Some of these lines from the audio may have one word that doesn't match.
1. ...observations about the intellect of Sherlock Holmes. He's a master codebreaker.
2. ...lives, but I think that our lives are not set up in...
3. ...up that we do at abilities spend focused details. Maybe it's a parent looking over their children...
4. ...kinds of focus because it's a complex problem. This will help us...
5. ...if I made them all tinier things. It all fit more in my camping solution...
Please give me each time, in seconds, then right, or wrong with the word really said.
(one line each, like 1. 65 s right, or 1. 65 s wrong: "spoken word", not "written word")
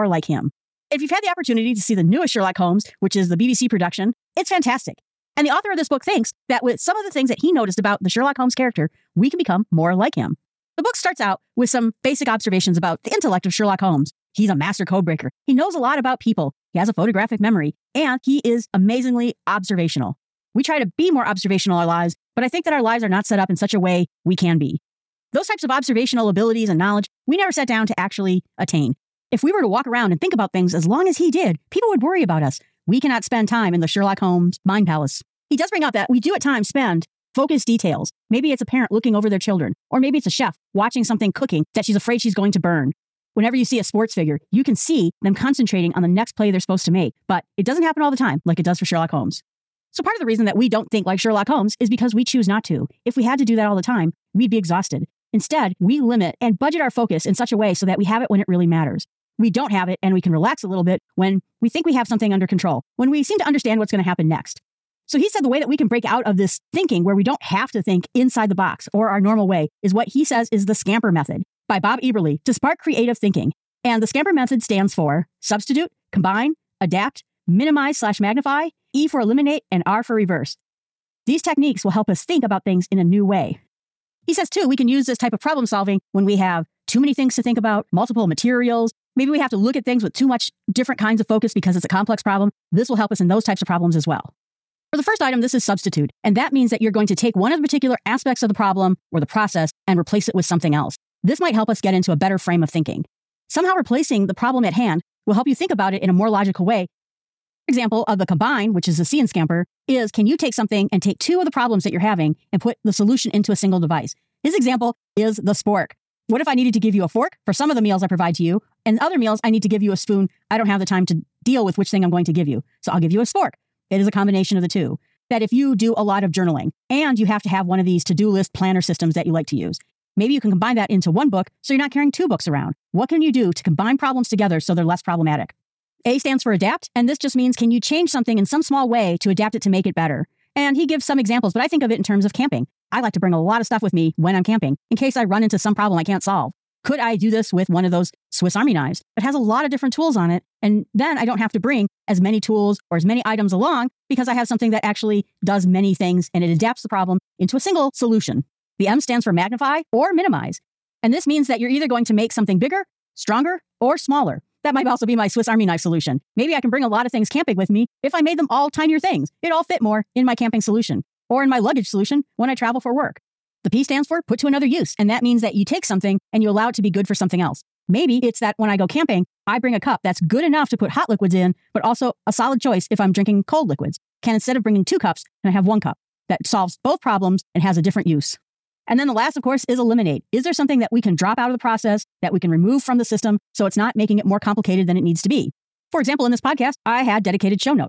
1. 12 s right
2. 21 s right
3. 35 s wrong: "times", not "abilities"
4. 90 s right
5. 168 s right.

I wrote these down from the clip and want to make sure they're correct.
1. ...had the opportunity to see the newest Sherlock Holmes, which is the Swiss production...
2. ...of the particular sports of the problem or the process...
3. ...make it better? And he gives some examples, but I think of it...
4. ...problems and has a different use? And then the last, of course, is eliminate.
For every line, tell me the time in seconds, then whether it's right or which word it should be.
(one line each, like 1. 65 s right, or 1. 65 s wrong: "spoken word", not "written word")
1. 1 s wrong: "BBC", not "Swiss"
2. 97 s wrong: "aspects", not "sports"
3. 139 s right
4. 186 s right.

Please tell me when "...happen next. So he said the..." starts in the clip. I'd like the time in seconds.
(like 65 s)
64 s.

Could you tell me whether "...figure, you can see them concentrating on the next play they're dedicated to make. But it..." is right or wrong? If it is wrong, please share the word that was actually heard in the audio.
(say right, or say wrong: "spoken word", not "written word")
wrong: "supposed", not "dedicated".